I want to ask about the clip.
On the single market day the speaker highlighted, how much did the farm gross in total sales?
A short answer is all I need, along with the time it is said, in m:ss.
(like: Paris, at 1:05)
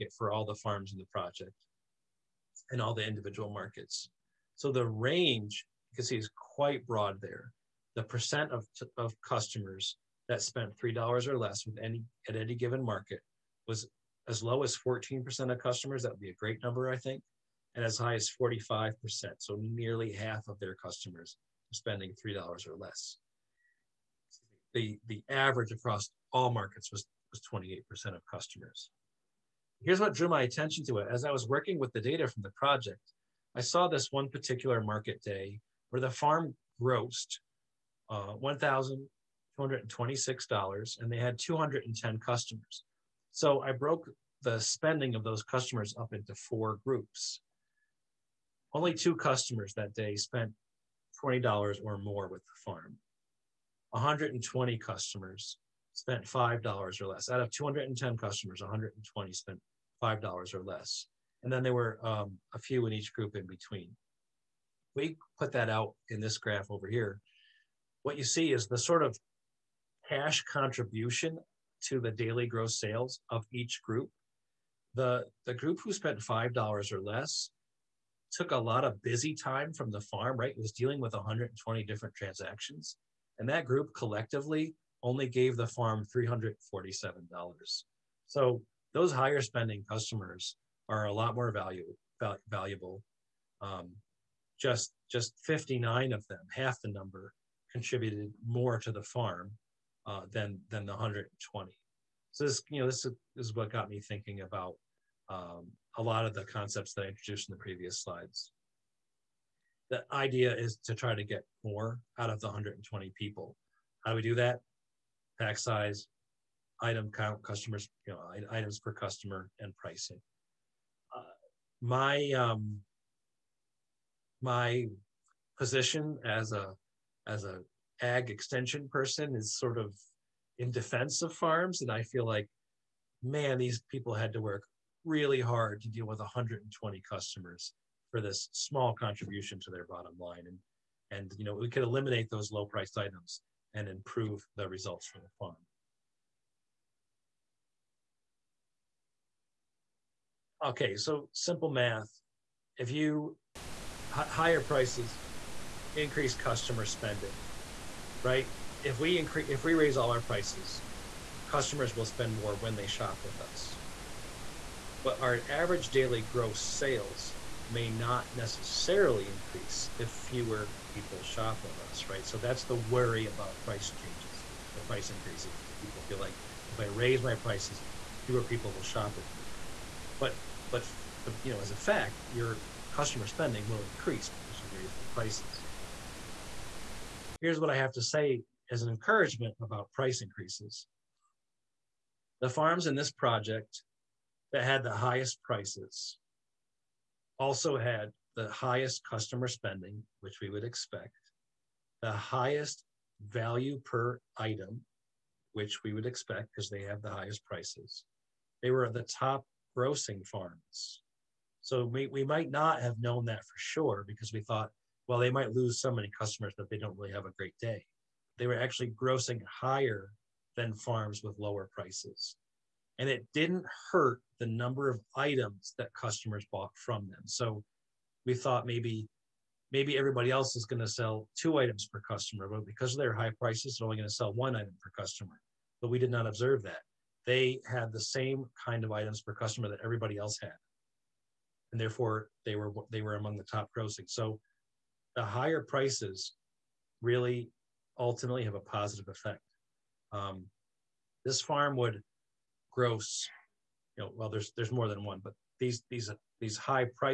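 $1,226, at 0:38.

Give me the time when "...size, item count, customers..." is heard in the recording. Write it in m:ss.
1:55.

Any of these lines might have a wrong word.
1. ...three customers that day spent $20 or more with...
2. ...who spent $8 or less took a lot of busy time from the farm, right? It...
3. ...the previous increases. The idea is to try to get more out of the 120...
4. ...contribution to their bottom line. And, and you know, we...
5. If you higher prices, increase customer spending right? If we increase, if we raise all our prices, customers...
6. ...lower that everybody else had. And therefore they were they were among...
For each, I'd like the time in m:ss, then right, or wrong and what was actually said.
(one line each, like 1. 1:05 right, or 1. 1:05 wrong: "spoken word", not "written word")
1. 0:48 wrong: "two", not "three"
2. 1:15 wrong: "5", not "8"
3. 1:47 wrong: "slides", not "increases"
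4. 2:18 right
5. 2:32 right
6. 3:59 wrong: "customer", not "lower".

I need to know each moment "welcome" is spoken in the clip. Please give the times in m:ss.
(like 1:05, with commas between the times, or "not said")
not said.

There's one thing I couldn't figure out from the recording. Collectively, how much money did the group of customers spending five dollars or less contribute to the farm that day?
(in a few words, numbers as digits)
$347.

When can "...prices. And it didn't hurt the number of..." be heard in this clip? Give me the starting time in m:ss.
3:41.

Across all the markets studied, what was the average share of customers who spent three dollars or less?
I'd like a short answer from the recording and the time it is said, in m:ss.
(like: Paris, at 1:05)
28%, at 0:27.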